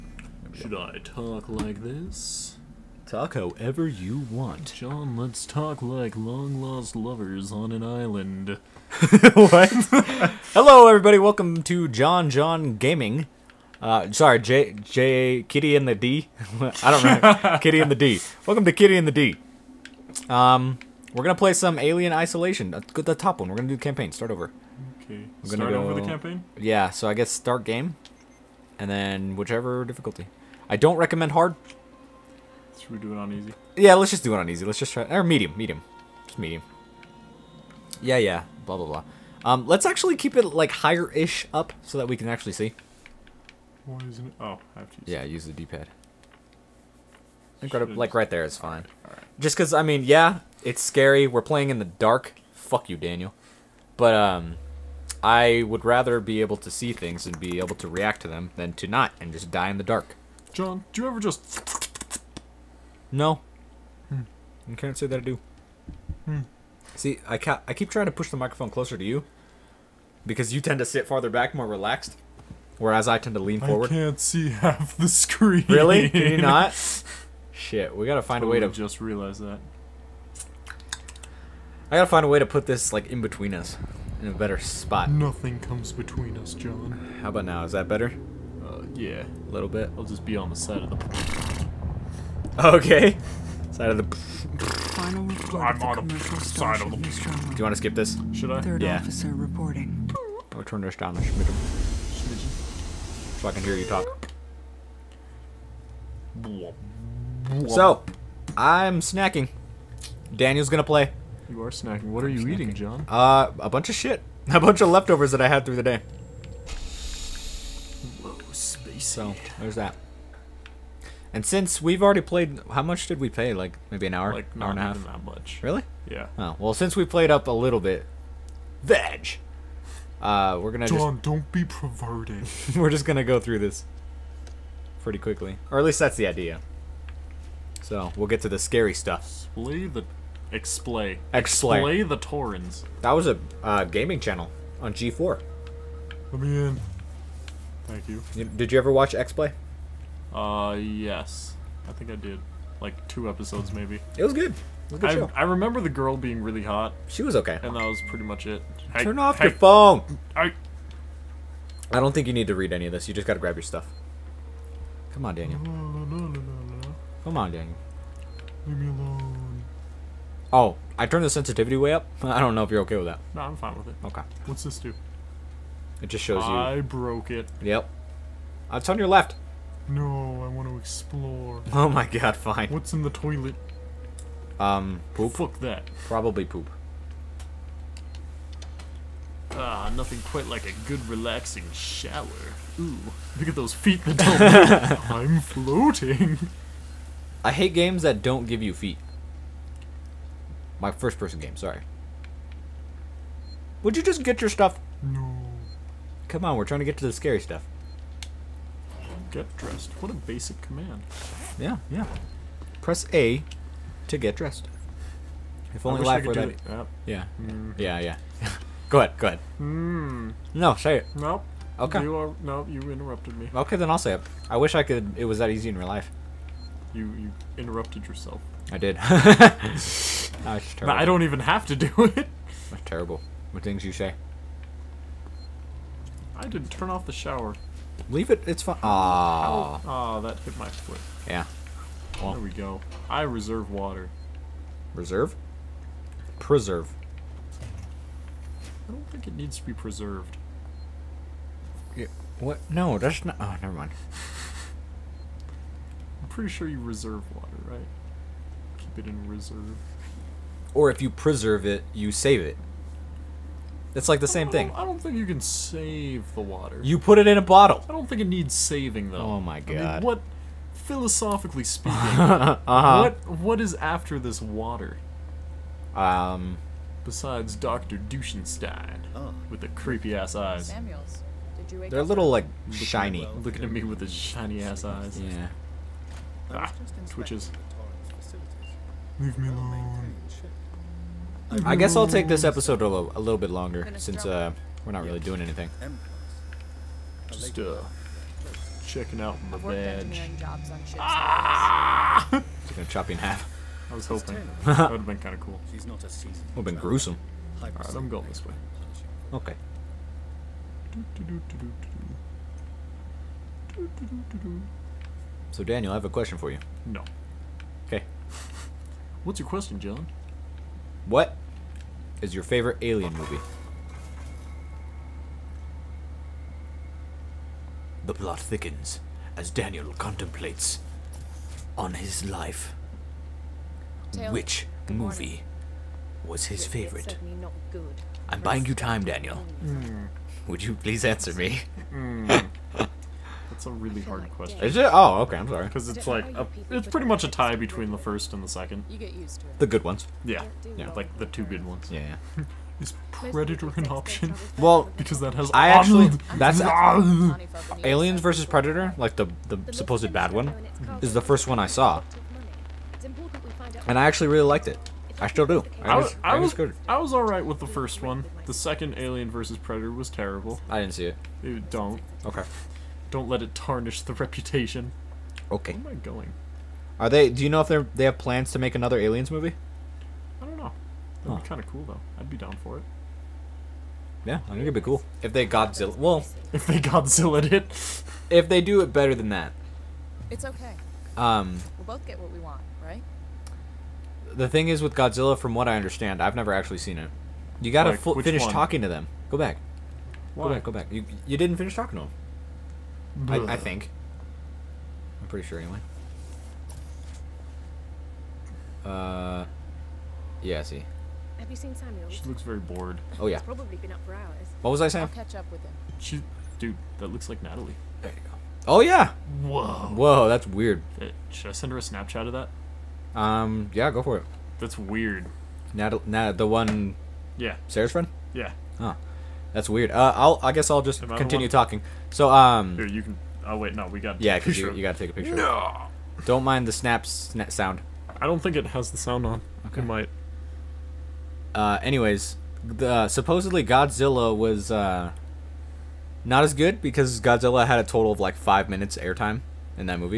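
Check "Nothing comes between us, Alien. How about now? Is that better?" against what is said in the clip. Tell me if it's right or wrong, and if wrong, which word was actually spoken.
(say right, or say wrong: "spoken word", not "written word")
wrong: "John", not "Alien".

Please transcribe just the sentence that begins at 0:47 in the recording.
Like, right, like right there is fine.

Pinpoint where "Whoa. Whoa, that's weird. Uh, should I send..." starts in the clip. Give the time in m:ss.
6:59.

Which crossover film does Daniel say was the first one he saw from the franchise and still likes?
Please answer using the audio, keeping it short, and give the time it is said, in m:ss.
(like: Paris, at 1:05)
Aliens versus Predator, at 5:57.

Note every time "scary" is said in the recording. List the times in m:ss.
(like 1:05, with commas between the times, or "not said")
0:50, 2:18, 3:27.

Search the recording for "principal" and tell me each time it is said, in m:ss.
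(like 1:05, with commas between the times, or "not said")
not said.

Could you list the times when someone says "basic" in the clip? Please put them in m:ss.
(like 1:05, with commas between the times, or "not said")
3:30.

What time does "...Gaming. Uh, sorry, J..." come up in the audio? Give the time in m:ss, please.
0:12.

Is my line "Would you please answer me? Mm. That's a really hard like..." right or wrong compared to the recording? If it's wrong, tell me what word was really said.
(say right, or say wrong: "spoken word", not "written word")
right.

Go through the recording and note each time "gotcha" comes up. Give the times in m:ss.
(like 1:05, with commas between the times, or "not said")
not said.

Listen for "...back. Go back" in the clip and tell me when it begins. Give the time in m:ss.
6:40.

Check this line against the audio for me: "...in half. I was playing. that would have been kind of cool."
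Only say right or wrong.
wrong.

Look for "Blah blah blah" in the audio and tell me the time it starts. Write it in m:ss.
0:38.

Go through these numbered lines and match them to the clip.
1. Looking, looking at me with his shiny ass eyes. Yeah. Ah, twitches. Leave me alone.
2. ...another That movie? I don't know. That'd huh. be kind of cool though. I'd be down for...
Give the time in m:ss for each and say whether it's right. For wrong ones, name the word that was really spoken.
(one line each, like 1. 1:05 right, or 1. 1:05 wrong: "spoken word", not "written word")
1. 4:43 right
2. 6:18 wrong: "Aliens", not "That".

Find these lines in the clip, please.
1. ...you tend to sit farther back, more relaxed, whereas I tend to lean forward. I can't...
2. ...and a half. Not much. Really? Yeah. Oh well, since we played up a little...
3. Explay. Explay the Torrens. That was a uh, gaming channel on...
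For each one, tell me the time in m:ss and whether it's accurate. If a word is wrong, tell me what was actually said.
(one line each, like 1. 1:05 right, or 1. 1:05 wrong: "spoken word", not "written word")
1. 1:10 right
2. 2:04 right
3. 2:21 right.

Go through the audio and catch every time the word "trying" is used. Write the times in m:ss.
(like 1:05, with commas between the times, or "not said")
1:07, 3:26.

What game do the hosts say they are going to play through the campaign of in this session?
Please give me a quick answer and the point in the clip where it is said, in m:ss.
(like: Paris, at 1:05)
Alien Isolation, at 0:21.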